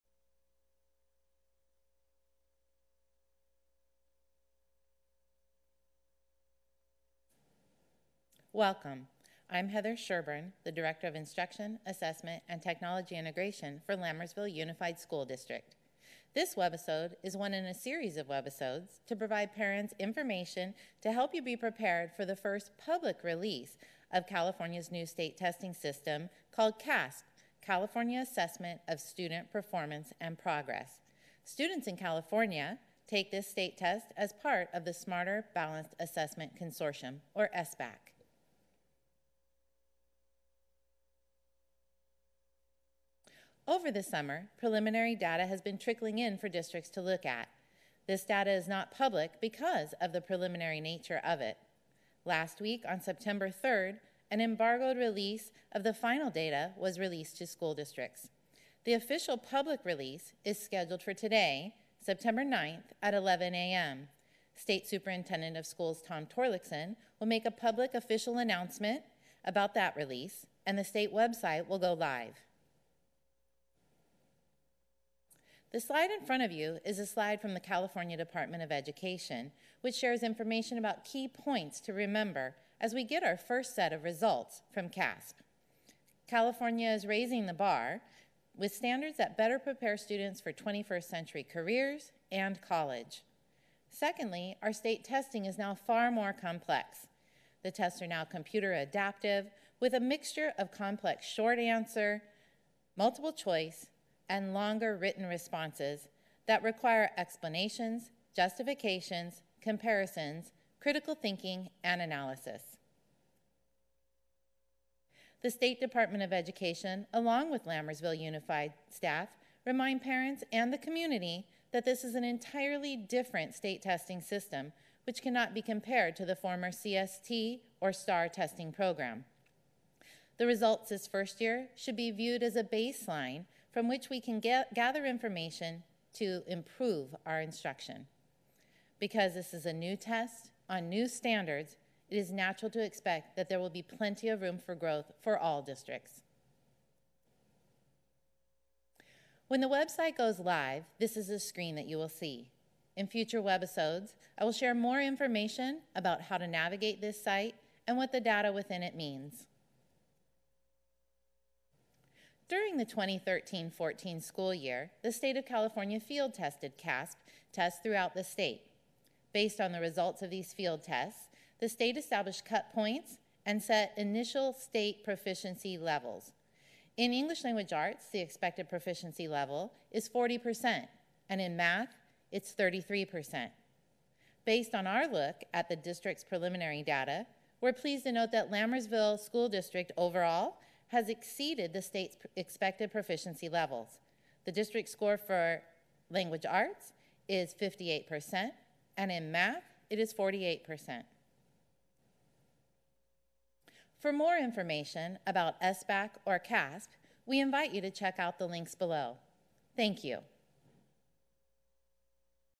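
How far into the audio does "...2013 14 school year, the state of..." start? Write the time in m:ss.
2:42.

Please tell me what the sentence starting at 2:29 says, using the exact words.
When the website goes live, this is the screen that you will see.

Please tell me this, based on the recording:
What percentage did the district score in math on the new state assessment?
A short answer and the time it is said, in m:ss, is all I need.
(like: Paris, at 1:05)
48%, at 3:20.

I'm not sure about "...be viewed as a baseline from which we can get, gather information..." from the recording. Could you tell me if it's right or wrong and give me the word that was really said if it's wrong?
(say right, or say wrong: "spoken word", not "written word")
right.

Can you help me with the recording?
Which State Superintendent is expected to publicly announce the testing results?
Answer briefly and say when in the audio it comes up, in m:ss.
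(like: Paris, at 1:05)
Tom Torlakson, at 1:06.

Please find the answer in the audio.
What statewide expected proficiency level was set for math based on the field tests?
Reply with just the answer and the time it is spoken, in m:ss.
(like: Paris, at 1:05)
33%, at 3:02.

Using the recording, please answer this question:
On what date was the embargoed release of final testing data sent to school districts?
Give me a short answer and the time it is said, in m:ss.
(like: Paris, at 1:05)
September 3rd, at 0:53.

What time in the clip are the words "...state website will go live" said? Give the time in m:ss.
1:10.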